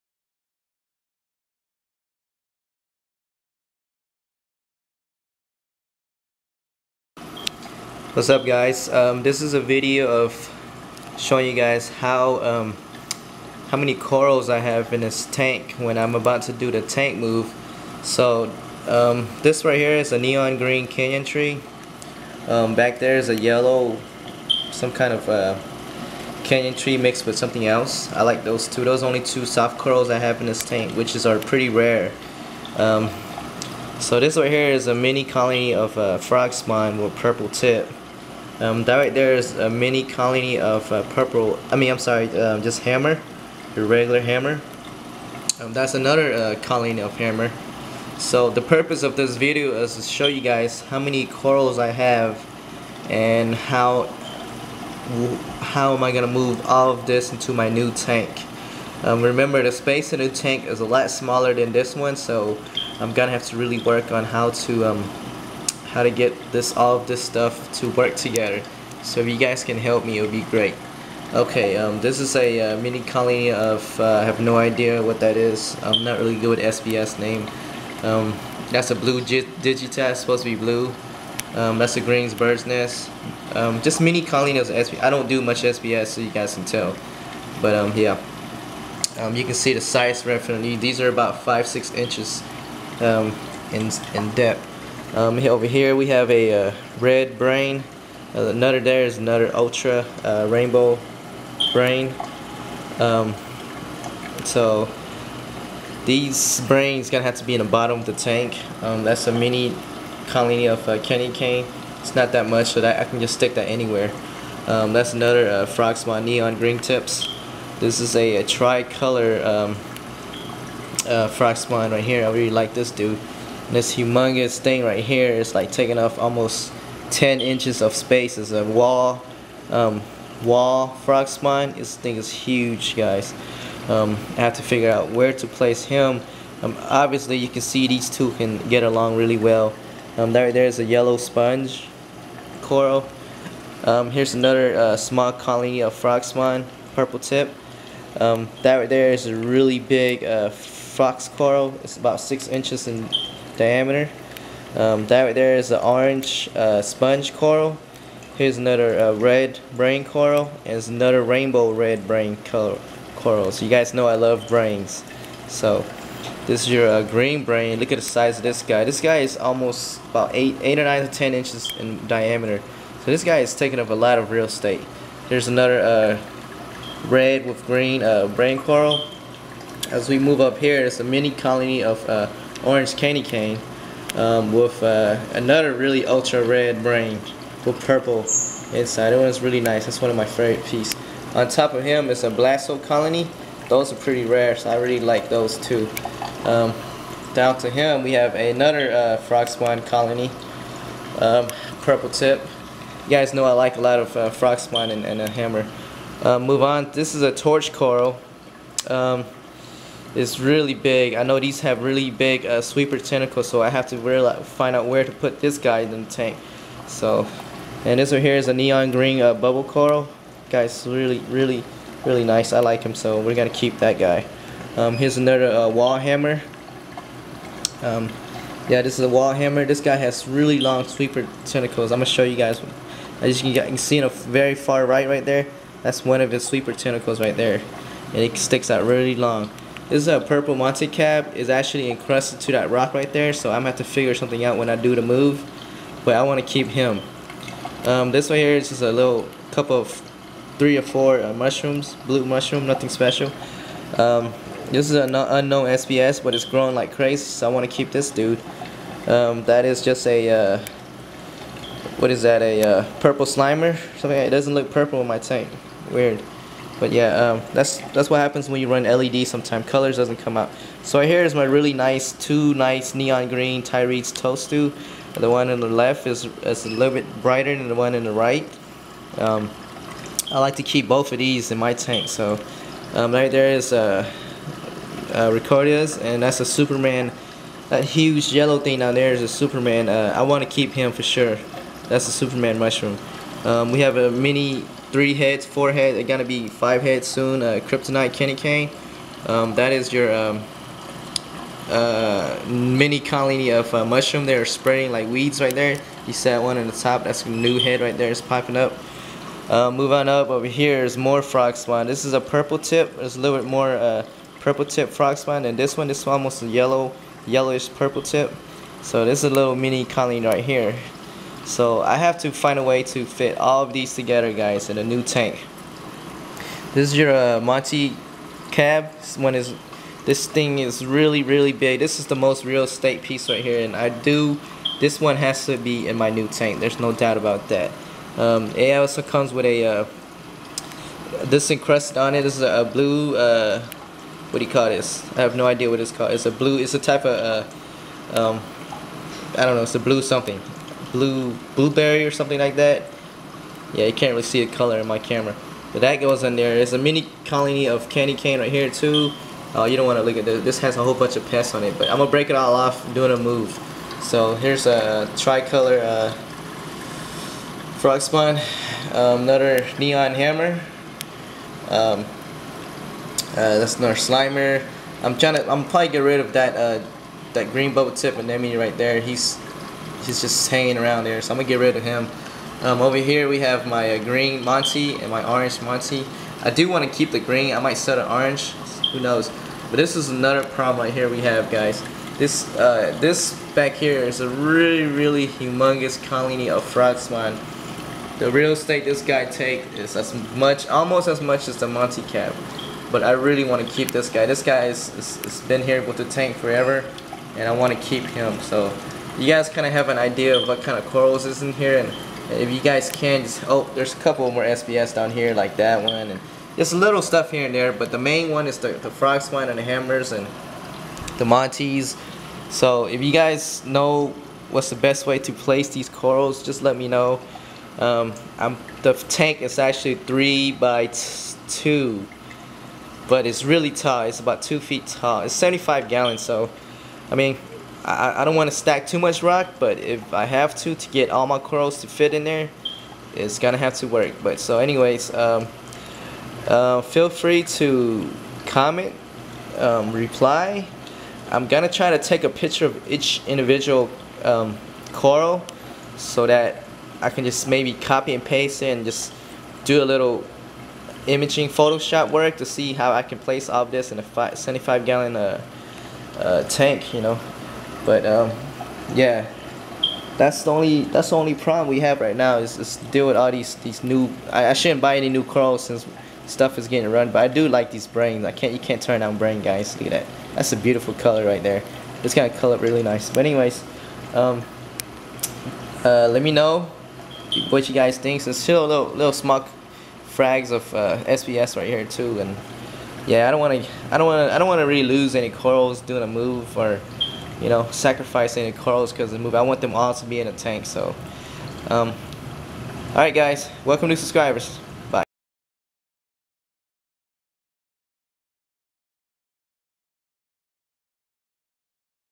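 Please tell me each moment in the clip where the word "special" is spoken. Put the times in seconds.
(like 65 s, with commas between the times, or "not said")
252 s.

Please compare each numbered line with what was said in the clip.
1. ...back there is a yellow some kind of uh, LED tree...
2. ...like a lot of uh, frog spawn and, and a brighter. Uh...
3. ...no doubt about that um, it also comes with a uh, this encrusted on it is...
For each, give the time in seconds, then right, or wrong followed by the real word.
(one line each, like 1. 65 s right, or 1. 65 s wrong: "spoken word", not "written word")
1. 22 s wrong: "Kenya", not "LED"
2. 203 s wrong: "hammer", not "brighter"
3. 336 s right.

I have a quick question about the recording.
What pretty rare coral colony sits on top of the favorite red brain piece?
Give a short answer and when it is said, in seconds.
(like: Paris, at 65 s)
Blasto, at 192 s.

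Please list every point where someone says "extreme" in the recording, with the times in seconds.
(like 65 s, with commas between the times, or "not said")
not said.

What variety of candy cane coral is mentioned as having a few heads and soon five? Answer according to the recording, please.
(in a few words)
Kryptonite.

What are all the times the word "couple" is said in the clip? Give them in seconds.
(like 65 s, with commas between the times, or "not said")
249 s, 413 s.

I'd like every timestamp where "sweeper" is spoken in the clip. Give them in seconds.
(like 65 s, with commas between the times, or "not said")
212 s, 230 s, 236 s.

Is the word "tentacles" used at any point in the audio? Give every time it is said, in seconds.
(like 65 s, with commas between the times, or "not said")
212 s, 231 s, 236 s.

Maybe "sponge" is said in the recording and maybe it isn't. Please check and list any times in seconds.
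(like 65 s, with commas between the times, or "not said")
141 s, 156 s.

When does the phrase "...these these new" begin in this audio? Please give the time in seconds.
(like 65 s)
473 s.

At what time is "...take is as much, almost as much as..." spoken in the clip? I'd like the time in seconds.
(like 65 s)
399 s.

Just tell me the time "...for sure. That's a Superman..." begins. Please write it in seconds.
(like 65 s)
290 s.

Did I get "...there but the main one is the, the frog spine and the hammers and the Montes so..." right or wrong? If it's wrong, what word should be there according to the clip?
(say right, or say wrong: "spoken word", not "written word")
right.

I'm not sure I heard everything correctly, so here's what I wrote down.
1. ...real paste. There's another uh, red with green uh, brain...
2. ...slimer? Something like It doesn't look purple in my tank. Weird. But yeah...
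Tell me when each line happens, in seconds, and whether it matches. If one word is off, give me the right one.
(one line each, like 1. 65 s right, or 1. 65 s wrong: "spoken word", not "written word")
1. 174 s wrong: "estate", not "paste"
2. 263 s right.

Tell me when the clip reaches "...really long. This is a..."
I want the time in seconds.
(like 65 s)
238 s.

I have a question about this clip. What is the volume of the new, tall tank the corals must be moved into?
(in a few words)
75 gallons.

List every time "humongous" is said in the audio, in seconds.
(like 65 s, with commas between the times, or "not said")
123 s, 395 s.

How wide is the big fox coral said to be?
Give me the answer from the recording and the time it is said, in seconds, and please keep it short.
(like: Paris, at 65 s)
6 inches, at 151 s.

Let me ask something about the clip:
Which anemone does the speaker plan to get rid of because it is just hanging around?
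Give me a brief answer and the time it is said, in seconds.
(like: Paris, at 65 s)
green bubble tip anemone, at 377 s.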